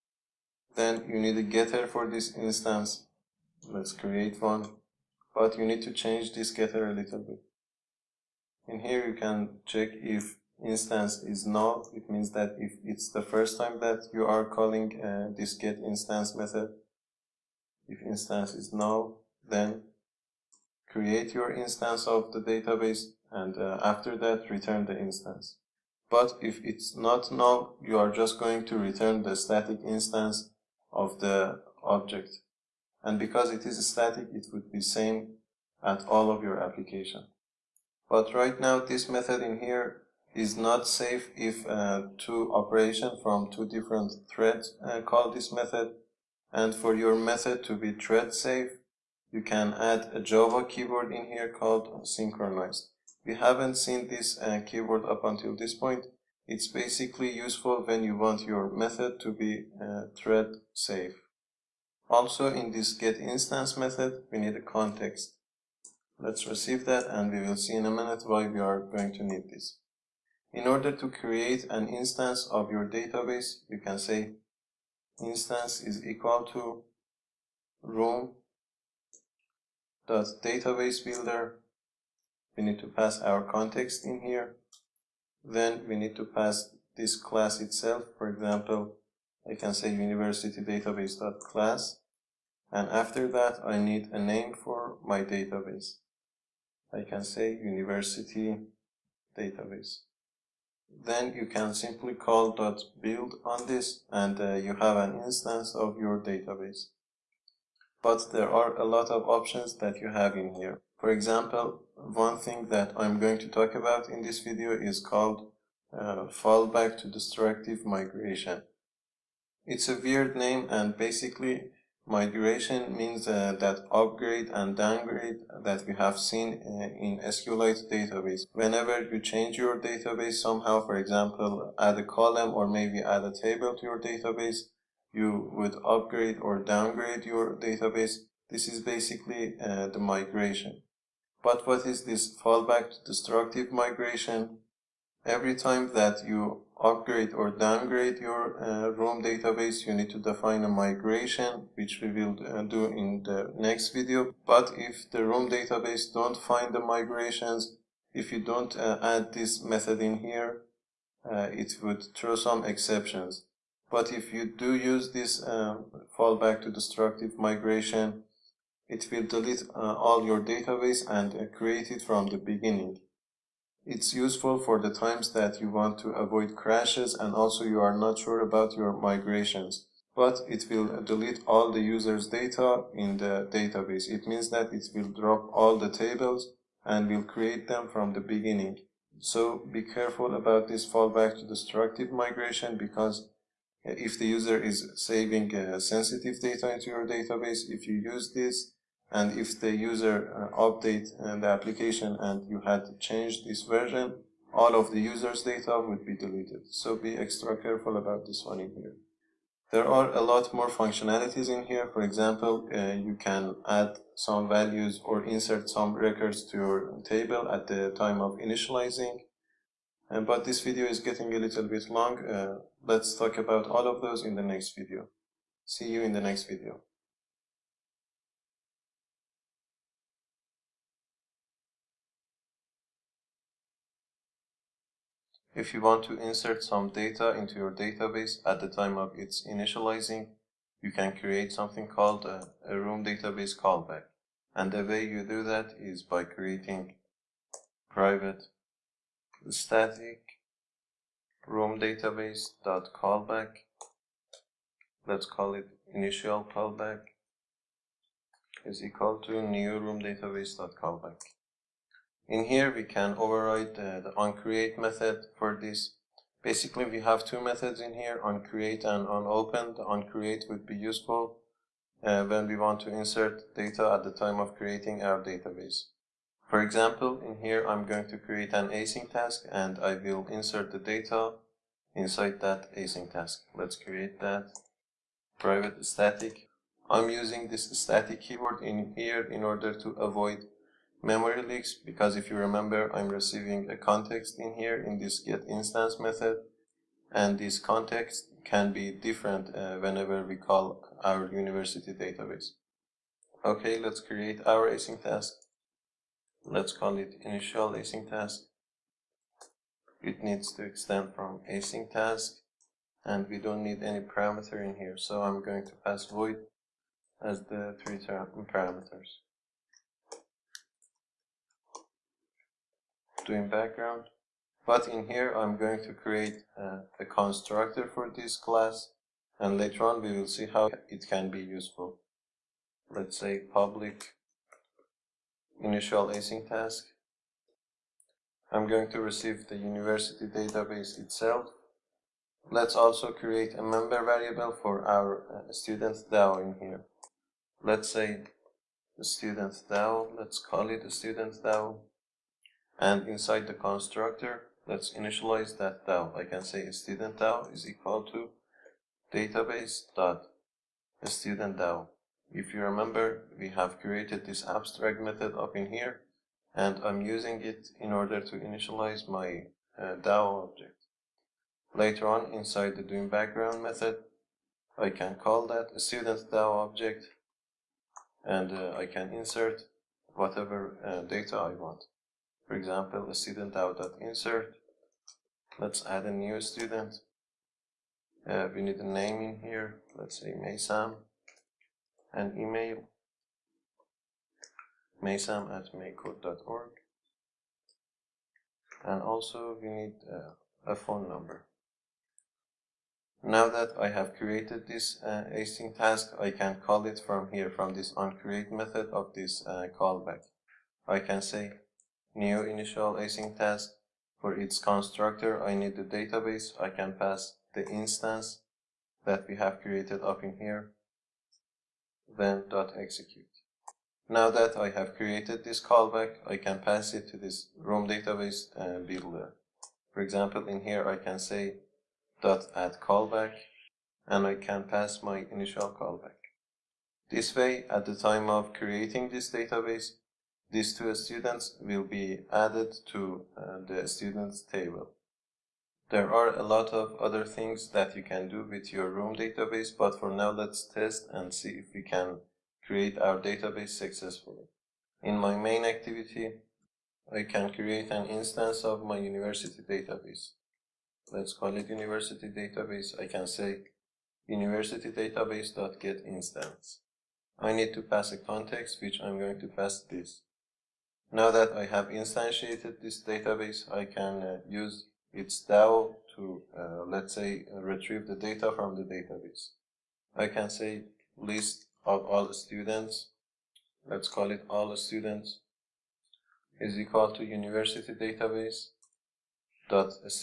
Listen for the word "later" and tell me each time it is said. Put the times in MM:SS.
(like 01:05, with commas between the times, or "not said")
05:29, 06:11.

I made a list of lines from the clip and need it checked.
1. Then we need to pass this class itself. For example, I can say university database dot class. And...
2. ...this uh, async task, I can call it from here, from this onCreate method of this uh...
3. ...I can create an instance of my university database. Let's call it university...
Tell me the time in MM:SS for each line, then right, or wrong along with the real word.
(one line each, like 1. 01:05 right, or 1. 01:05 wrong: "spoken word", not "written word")
1. 01:25 right
2. 06:44 right
3. 07:37 right.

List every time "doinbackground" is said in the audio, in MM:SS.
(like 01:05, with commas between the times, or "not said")
05:23, 06:12.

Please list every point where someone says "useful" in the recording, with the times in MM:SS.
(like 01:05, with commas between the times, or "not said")
00:57, 02:54, 04:30, 05:31.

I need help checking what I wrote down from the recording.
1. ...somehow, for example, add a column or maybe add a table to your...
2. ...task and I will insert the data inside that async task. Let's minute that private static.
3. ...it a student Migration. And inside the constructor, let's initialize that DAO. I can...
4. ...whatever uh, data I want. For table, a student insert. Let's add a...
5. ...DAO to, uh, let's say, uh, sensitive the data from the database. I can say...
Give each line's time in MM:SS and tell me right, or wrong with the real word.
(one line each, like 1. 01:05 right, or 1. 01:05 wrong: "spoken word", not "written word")
1. 02:10 right
2. 04:39 wrong: "create", not "minute"
3. 05:50 wrong: "DAO", not "Migration"
4. 06:20 wrong: "example", not "table"
5. 07:55 wrong: "retrieve", not "sensitive".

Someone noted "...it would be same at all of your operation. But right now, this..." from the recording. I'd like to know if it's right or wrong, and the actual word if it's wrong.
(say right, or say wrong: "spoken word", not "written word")
wrong: "application", not "operation".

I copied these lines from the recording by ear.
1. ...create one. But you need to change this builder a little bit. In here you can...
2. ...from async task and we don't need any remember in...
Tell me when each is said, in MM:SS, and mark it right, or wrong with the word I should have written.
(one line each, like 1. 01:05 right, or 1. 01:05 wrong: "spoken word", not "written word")
1. 00:03 wrong: "getter", not "builder"
2. 05:11 wrong: "parameter", not "remember".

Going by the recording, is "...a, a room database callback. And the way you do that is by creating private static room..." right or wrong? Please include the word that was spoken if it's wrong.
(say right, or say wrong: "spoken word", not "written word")
right.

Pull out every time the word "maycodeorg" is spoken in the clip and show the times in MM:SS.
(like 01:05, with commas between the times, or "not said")
06:35.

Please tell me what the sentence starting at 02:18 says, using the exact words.
This is basically uh, the migration.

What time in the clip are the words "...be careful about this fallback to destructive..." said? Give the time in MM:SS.
03:09.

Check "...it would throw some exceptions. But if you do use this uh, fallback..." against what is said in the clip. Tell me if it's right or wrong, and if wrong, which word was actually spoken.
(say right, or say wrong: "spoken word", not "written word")
right.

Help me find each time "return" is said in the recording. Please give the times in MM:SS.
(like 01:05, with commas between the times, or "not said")
00:24, 00:28.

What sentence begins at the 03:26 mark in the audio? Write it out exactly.
So be extra careful about this one in here.